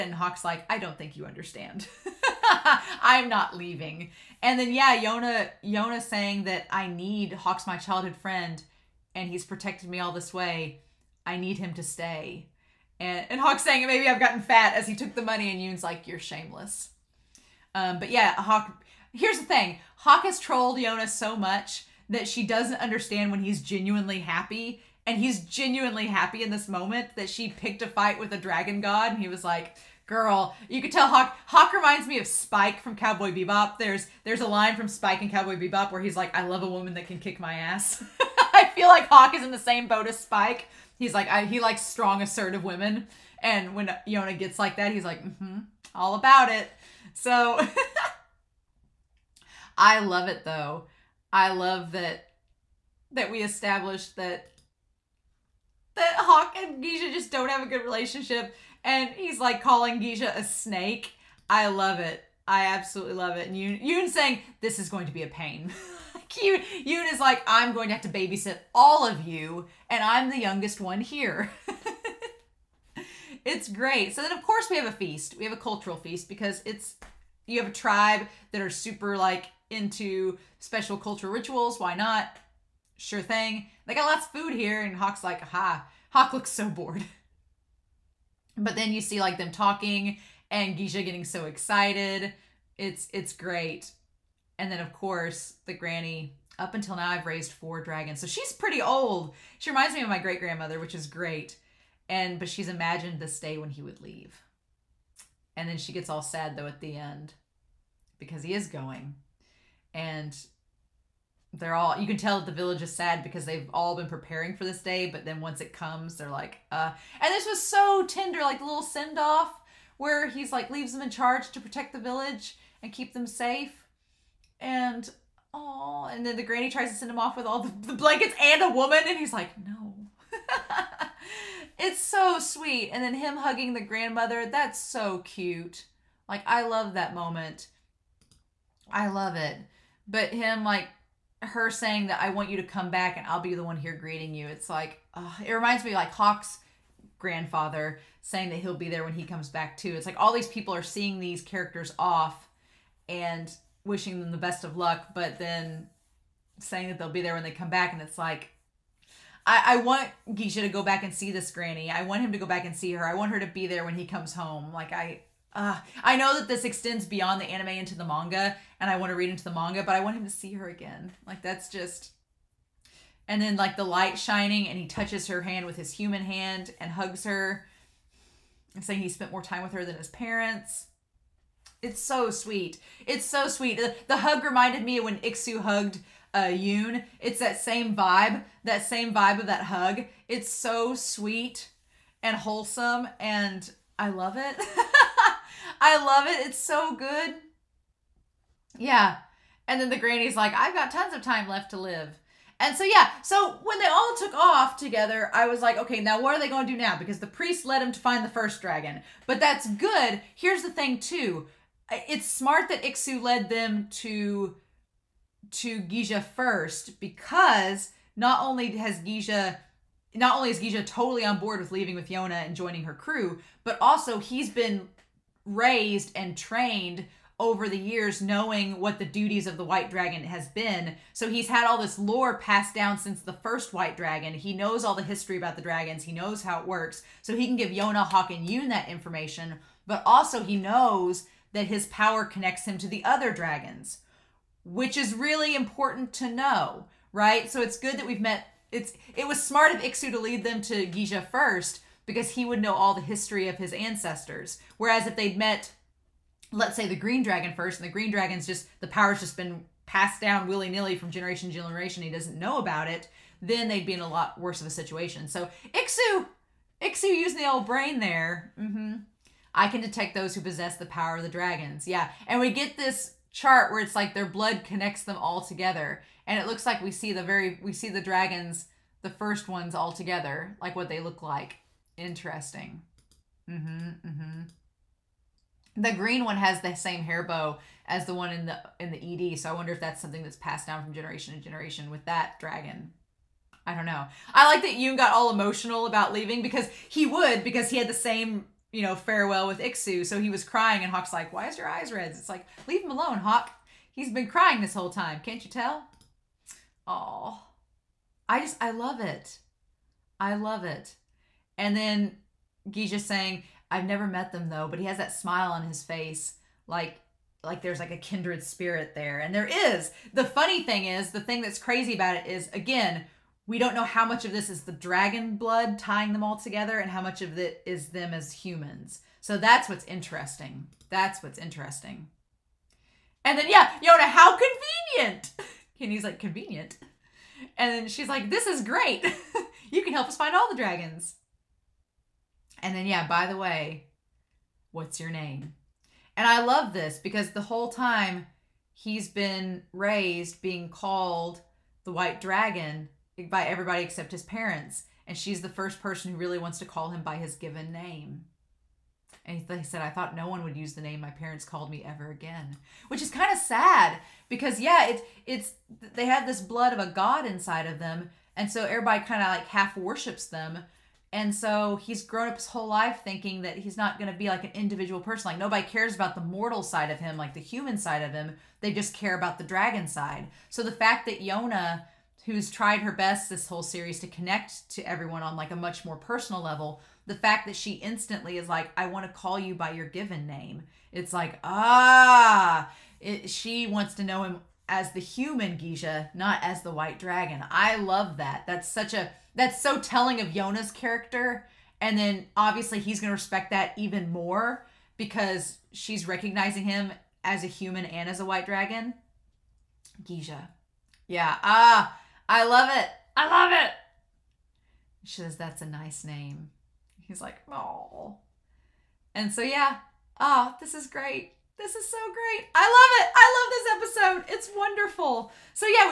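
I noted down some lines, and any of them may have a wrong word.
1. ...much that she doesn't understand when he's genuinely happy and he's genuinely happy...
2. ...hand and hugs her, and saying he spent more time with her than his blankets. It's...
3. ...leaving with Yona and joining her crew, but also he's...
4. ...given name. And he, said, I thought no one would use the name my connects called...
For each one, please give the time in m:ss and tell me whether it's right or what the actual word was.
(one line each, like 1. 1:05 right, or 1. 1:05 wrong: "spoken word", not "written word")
1. 0:21 right
2. 2:56 wrong: "parents", not "blankets"
3. 3:41 right
4. 5:57 wrong: "parents", not "connects".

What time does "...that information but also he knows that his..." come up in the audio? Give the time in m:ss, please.
3:58.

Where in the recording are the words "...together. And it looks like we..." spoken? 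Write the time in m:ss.
4:35.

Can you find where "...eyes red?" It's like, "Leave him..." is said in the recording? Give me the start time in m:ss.
5:01.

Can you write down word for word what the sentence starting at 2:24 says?
It's like uh, it reminds me like Hak's grandfather saying that he'll be there when he comes back too.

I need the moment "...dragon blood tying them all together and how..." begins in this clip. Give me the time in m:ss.
5:24.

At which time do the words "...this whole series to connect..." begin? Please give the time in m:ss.
6:23.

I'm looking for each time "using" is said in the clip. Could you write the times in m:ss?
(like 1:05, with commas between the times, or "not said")
4:27.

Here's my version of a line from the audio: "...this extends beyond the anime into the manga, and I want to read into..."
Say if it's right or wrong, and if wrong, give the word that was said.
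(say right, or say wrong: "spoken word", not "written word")
right.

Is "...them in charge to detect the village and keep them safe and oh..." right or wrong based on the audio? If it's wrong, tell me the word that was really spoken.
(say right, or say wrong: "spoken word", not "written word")
wrong: "protect", not "detect".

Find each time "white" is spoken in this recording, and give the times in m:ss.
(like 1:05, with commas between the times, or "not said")
3:49, 3:53, 5:51, 6:36, 6:48.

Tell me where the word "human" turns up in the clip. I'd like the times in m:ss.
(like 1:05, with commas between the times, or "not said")
2:55, 5:28, 6:17, 6:35, 6:47.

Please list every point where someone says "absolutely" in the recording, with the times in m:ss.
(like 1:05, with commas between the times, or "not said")
1:02.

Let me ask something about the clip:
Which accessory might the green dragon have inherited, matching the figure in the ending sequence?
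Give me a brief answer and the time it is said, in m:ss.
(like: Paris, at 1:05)
Hair bow, at 4:47.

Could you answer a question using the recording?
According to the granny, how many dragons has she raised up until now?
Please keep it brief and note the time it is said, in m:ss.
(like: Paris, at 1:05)
4, at 1:37.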